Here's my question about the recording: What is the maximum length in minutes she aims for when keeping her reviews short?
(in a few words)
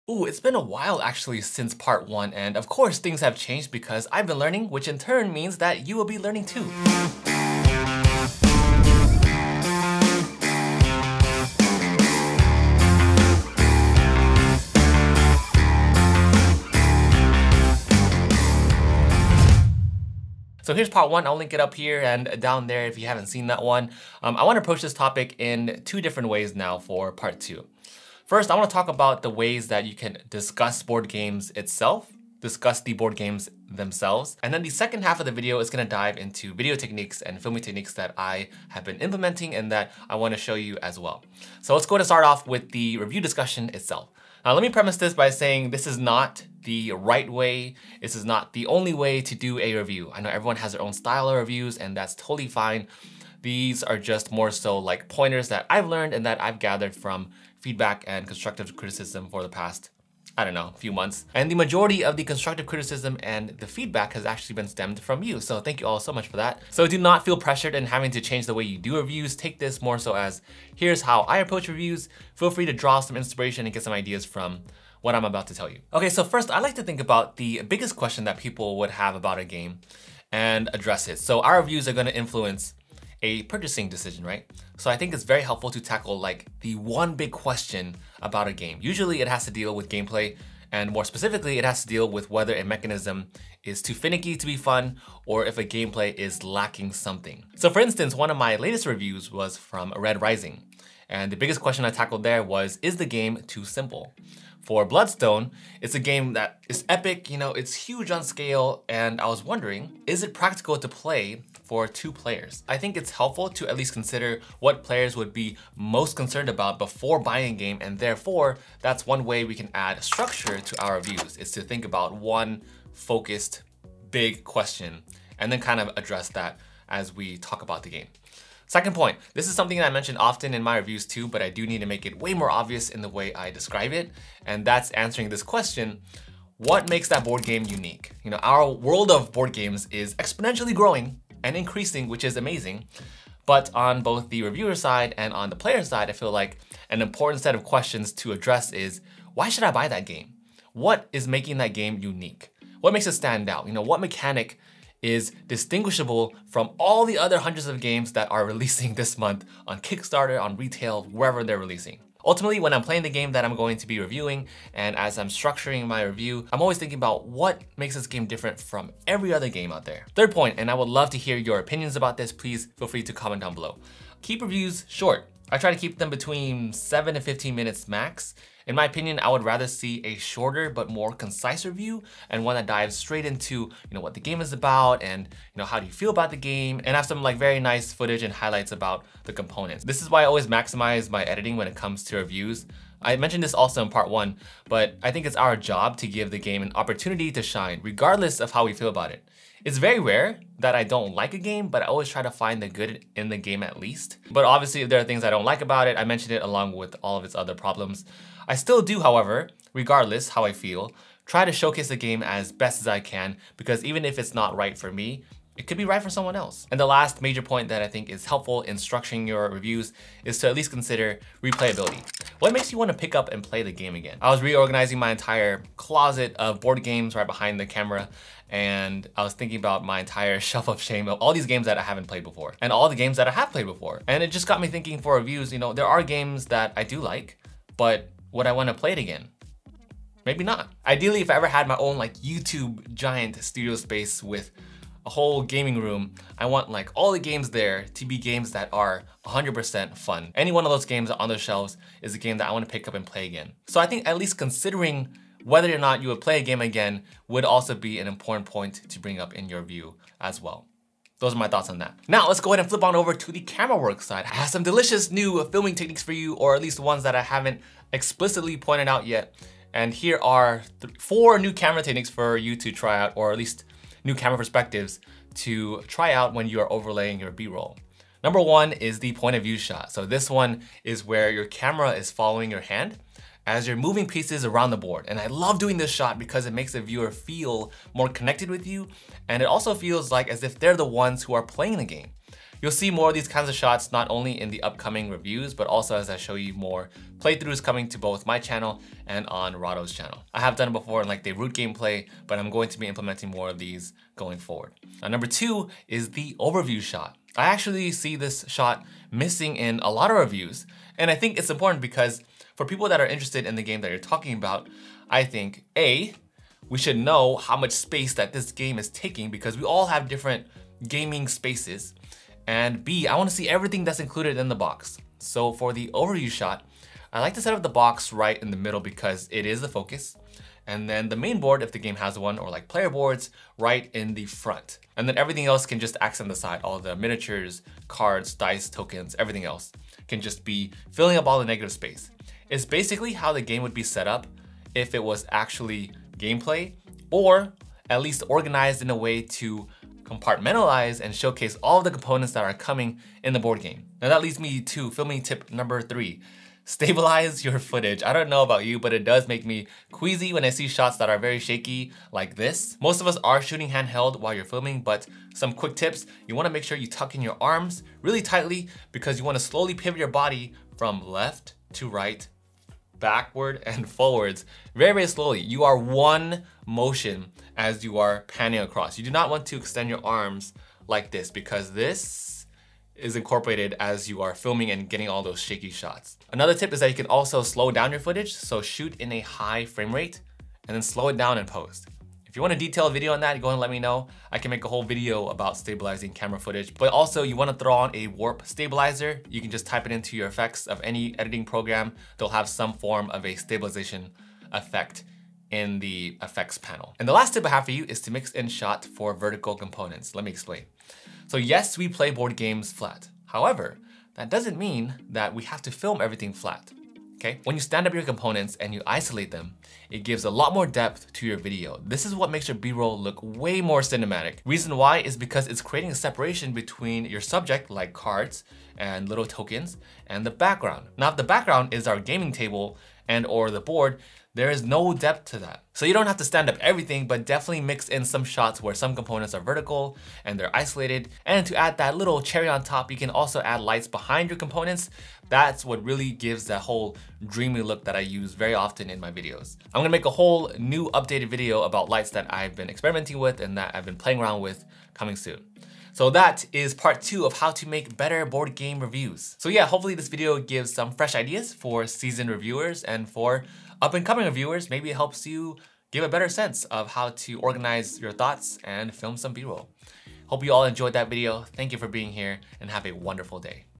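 15.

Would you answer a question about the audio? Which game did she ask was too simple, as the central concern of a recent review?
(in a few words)
Red Rising.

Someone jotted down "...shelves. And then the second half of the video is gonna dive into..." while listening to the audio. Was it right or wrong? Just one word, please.
wrong.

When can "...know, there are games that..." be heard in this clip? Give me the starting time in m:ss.
3:55.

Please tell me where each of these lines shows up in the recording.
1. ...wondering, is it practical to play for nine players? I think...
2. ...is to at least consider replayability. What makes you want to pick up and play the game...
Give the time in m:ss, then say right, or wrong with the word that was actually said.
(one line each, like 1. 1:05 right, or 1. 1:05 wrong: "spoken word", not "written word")
1. 1:49 wrong: "two", not "nine"
2. 3:40 right.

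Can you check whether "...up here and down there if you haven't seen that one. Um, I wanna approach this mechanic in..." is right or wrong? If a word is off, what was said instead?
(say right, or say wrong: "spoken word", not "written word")
wrong: "topic", not "mechanic".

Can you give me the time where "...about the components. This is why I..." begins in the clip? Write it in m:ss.
3:08.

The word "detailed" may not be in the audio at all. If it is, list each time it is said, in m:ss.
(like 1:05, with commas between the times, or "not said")
6:32.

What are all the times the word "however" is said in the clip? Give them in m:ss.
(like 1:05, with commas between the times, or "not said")
3:29, 6:53.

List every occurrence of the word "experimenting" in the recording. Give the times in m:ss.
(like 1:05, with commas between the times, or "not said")
7:32.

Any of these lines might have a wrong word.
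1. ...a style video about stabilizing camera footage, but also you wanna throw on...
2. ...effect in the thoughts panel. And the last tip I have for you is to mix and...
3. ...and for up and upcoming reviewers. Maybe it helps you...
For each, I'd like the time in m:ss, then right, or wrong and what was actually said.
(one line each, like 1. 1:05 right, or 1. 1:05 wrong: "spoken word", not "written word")
1. 6:34 wrong: "whole", not "style"
2. 6:44 wrong: "effects", not "thoughts"
3. 7:42 wrong: "coming", not "upcoming".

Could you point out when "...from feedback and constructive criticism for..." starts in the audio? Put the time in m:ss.
0:56.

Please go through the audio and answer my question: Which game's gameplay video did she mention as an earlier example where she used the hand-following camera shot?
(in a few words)
Root.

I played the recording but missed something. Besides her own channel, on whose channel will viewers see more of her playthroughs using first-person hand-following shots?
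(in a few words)
Rahdo.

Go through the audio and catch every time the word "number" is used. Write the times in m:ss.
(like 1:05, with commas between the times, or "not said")
4:38, 5:05, 5:55.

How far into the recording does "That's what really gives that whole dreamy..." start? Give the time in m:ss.
7:25.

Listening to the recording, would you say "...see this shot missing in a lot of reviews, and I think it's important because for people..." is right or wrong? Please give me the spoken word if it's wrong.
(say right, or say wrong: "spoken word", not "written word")
right.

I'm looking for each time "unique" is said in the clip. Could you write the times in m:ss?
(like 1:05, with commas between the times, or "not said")
2:17, 2:31.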